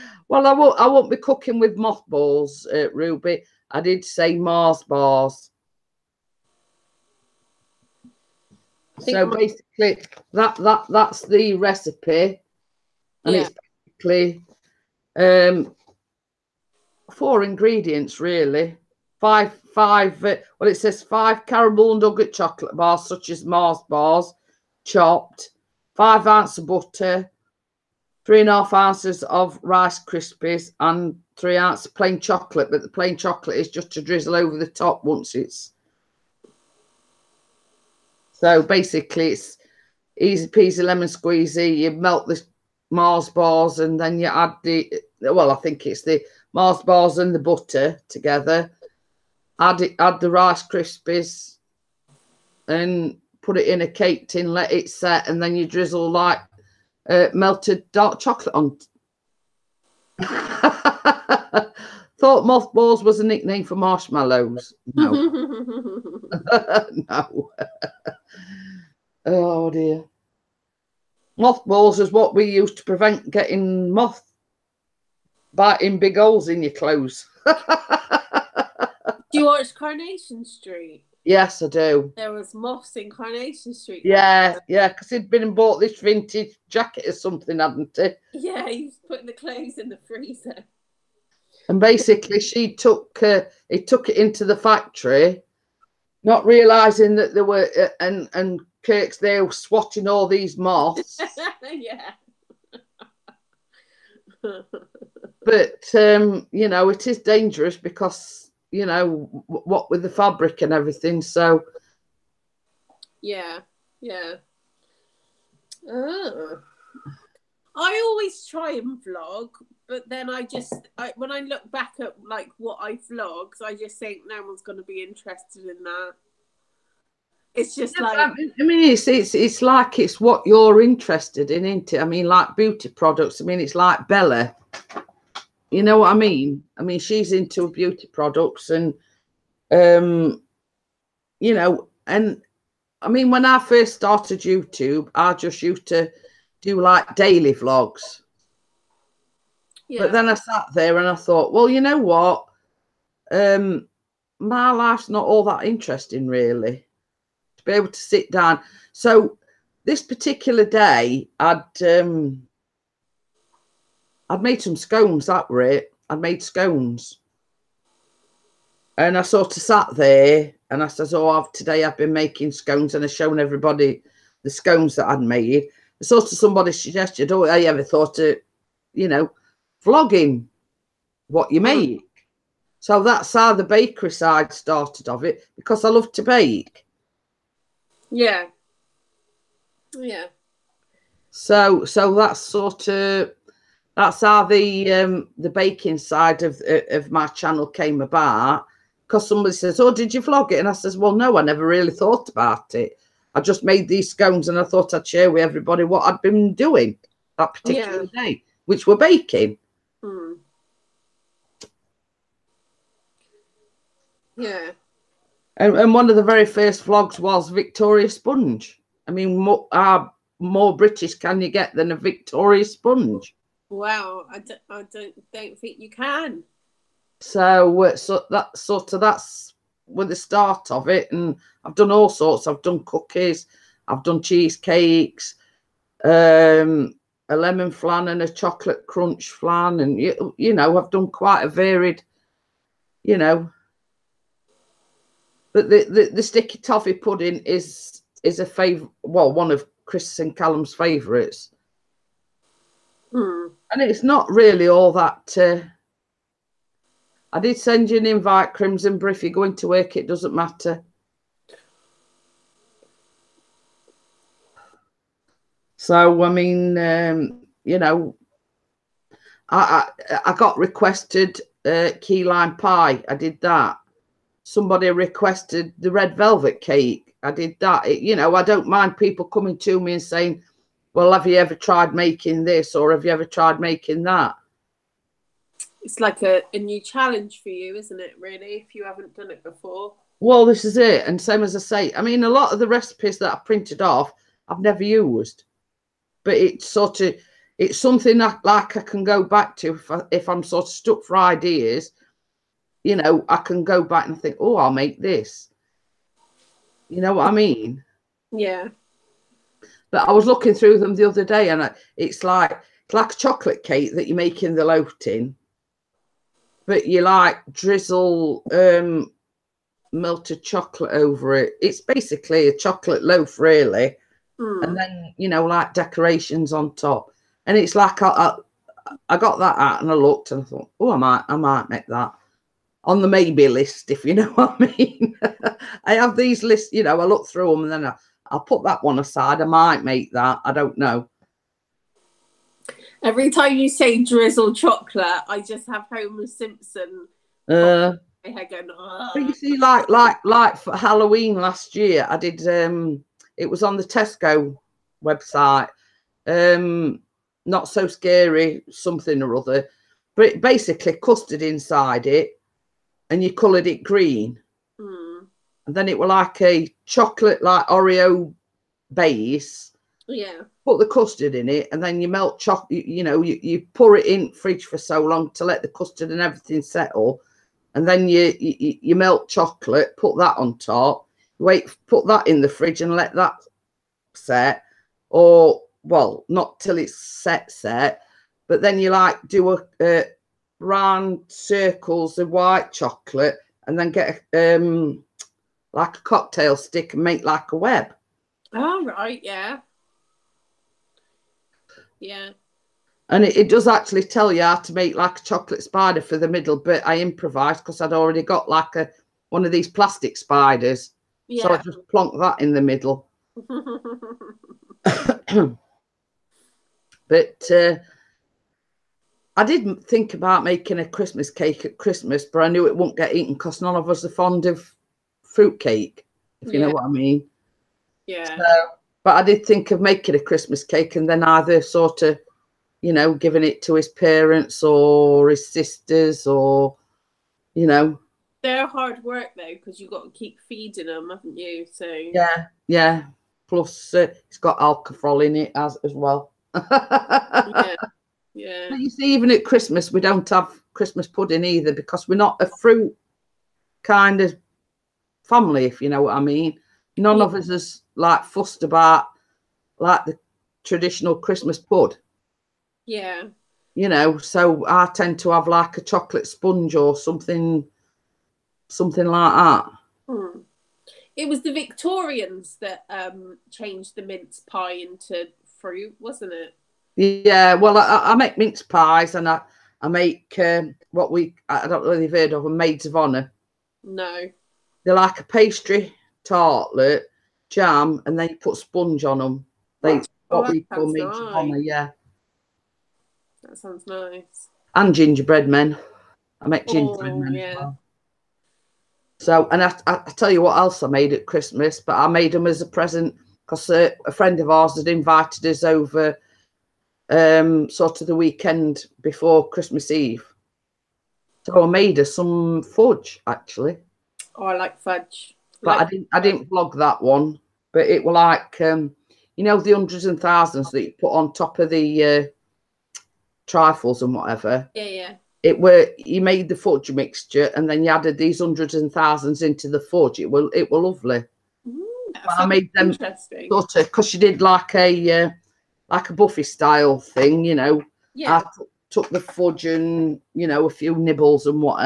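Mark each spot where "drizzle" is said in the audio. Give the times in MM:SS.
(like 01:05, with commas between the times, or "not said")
00:34, 00:55, 05:17, 05:44.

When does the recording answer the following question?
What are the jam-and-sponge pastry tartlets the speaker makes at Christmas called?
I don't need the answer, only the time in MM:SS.
08:02.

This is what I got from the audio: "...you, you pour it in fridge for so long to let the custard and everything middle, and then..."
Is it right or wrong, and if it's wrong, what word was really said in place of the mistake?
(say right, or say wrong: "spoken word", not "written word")
wrong: "settle", not "middle".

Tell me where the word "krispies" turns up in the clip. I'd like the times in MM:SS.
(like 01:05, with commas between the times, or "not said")
00:30, 00:50.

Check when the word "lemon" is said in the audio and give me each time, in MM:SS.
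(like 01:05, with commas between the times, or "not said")
00:40, 03:57.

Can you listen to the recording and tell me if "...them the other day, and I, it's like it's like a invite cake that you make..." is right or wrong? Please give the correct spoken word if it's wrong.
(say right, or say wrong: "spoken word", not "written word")
wrong: "chocolate", not "invite".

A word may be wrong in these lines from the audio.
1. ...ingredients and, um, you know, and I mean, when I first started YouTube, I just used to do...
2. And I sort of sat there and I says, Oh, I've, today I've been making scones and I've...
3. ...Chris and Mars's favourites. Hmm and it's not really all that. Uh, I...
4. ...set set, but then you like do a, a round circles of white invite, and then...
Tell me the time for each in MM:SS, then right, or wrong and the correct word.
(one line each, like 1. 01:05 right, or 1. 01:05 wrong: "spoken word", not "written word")
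1. 02:18 wrong: "products", not "ingredients"
2. 02:48 right
3. 04:09 wrong: "Callum", not "Mars"
4. 06:26 wrong: "chocolate", not "invite".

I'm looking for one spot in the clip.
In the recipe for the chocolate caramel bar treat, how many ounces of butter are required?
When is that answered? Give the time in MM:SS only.
00:25.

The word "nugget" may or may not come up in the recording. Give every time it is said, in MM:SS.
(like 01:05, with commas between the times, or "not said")
00:21.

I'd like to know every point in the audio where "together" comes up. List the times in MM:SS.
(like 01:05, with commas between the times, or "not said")
00:48.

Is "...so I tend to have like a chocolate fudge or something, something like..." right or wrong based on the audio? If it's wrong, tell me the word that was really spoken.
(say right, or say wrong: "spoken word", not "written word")
wrong: "sponge", not "fudge".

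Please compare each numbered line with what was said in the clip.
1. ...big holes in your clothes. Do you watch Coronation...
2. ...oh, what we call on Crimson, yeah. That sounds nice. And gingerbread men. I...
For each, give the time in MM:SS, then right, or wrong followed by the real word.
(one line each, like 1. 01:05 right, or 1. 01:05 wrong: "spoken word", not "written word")
1. 01:15 right
2. 08:10 wrong: "Honor", not "Crimson".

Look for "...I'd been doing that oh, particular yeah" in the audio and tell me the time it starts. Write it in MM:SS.
03:26.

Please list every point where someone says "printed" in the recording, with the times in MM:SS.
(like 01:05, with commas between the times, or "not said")
04:53.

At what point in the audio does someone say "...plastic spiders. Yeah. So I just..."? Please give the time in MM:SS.
06:49.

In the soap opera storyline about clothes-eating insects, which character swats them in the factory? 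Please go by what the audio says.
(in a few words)
Kirk.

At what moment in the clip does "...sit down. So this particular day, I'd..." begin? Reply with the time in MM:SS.
02:38.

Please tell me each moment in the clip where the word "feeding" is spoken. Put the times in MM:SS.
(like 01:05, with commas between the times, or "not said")
07:20.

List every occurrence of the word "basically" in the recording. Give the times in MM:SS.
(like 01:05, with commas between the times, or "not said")
00:09, 00:13, 00:38, 01:31, 05:21, 06:00.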